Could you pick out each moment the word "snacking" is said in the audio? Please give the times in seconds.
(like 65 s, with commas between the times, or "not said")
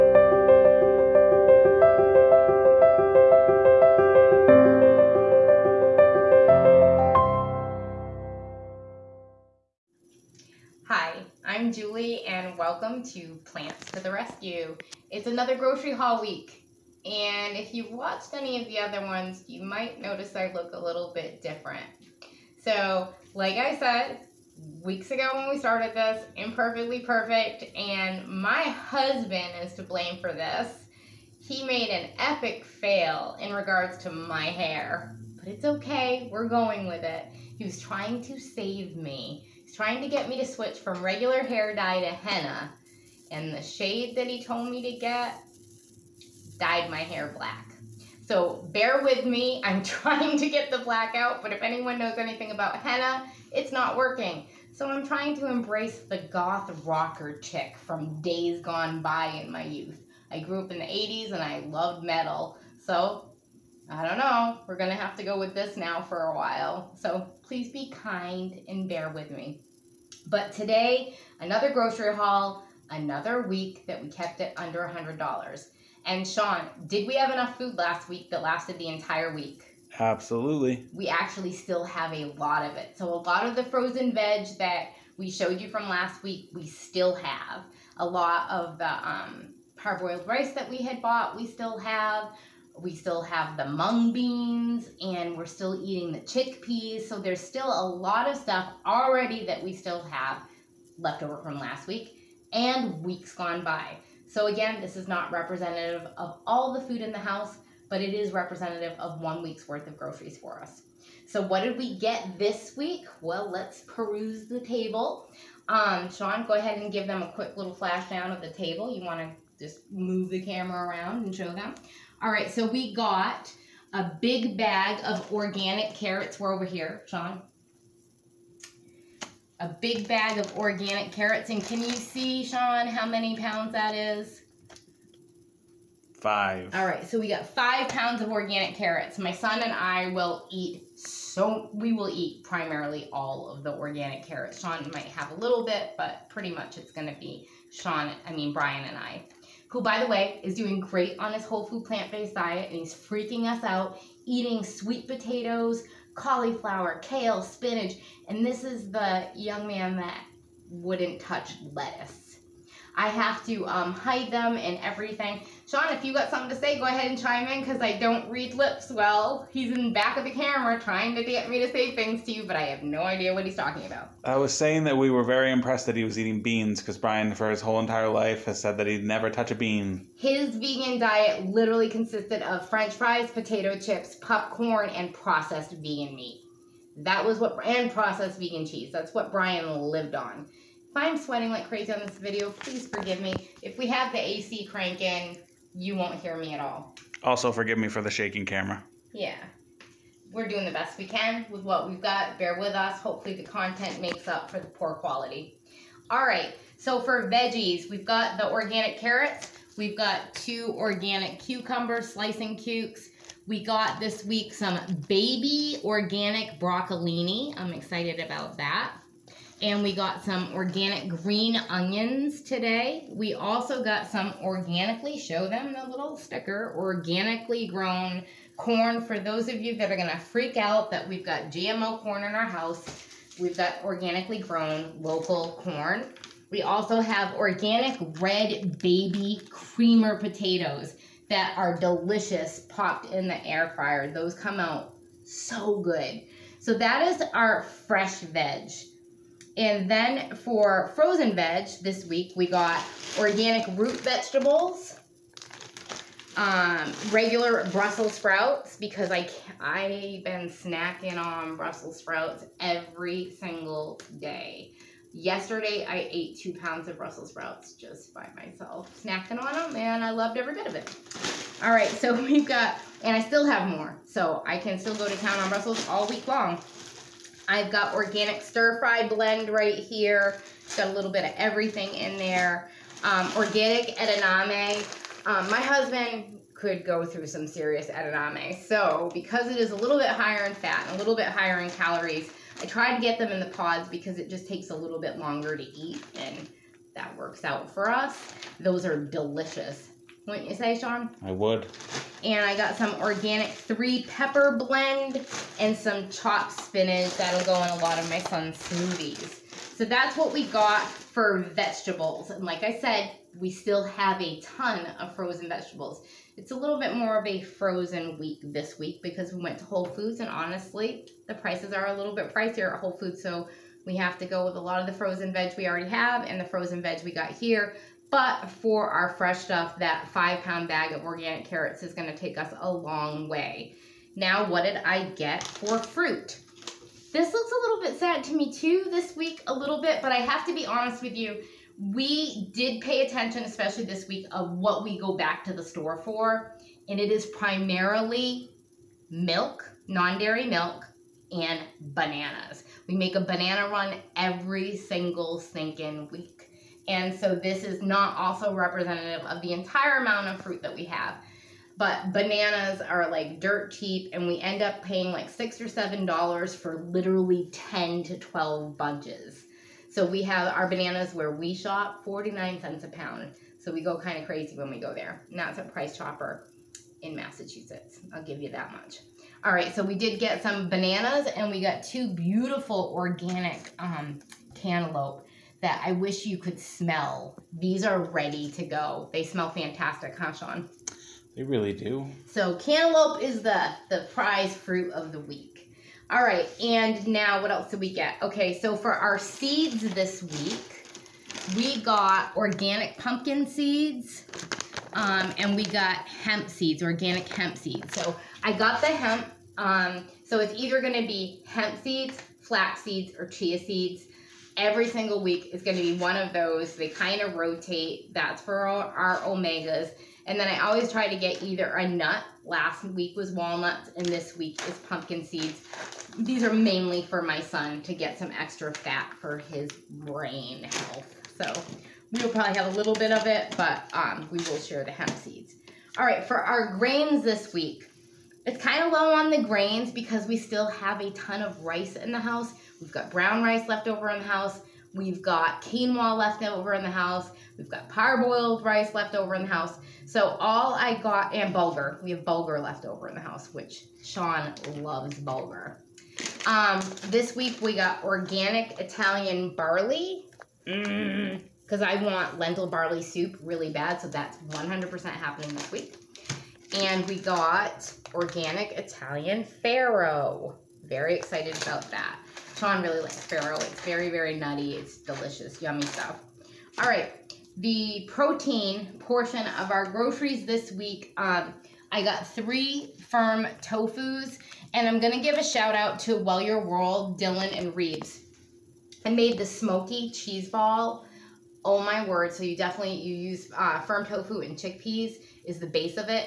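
260 s, 269 s.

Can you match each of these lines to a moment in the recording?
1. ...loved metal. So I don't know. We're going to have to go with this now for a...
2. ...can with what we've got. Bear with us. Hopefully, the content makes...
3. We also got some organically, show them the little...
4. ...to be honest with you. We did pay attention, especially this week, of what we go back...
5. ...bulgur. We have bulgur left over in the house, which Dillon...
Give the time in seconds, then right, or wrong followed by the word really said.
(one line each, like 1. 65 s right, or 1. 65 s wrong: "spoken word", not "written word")
1. 61 s right
2. 201 s right
3. 223 s right
4. 340 s right
5. 451 s wrong: "Sean", not "Dillon".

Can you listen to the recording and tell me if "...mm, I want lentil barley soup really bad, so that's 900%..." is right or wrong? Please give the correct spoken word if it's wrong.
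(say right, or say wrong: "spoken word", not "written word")
wrong: "100", not "900".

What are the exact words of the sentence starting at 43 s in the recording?
And the shade that he told me to get dyed my hair black.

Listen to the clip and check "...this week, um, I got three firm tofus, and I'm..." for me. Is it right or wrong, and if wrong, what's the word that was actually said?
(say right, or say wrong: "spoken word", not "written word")
right.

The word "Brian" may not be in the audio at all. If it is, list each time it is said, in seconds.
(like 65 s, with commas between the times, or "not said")
148 s, 176 s, 189 s.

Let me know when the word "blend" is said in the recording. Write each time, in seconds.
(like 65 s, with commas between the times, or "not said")
279 s, 304 s.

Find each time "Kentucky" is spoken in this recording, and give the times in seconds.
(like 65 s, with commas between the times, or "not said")
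not said.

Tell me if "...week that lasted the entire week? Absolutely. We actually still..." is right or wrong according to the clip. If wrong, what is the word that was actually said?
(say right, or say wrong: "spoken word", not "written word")
right.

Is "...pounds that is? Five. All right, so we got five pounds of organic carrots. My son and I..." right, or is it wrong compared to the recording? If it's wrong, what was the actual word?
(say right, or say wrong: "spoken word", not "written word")
right.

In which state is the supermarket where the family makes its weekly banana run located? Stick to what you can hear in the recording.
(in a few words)
Massachusetts.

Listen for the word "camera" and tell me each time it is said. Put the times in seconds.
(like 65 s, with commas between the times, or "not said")
120 s, 170 s, 198 s.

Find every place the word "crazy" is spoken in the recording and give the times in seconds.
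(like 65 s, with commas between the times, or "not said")
191 s, 374 s.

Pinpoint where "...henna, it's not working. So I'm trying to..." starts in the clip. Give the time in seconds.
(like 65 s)
52 s.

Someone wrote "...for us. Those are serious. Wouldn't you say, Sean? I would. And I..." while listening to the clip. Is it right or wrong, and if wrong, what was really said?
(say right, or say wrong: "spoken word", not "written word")
wrong: "delicious", not "serious".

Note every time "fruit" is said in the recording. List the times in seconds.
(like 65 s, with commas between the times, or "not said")
335 s, 360 s, 394 s.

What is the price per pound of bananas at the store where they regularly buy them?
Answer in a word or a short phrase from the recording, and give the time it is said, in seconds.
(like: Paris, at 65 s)
49 cents, at 372 s.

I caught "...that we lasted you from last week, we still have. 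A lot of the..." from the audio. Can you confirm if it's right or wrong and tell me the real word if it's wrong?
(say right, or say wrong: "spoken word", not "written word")
wrong: "showed", not "lasted".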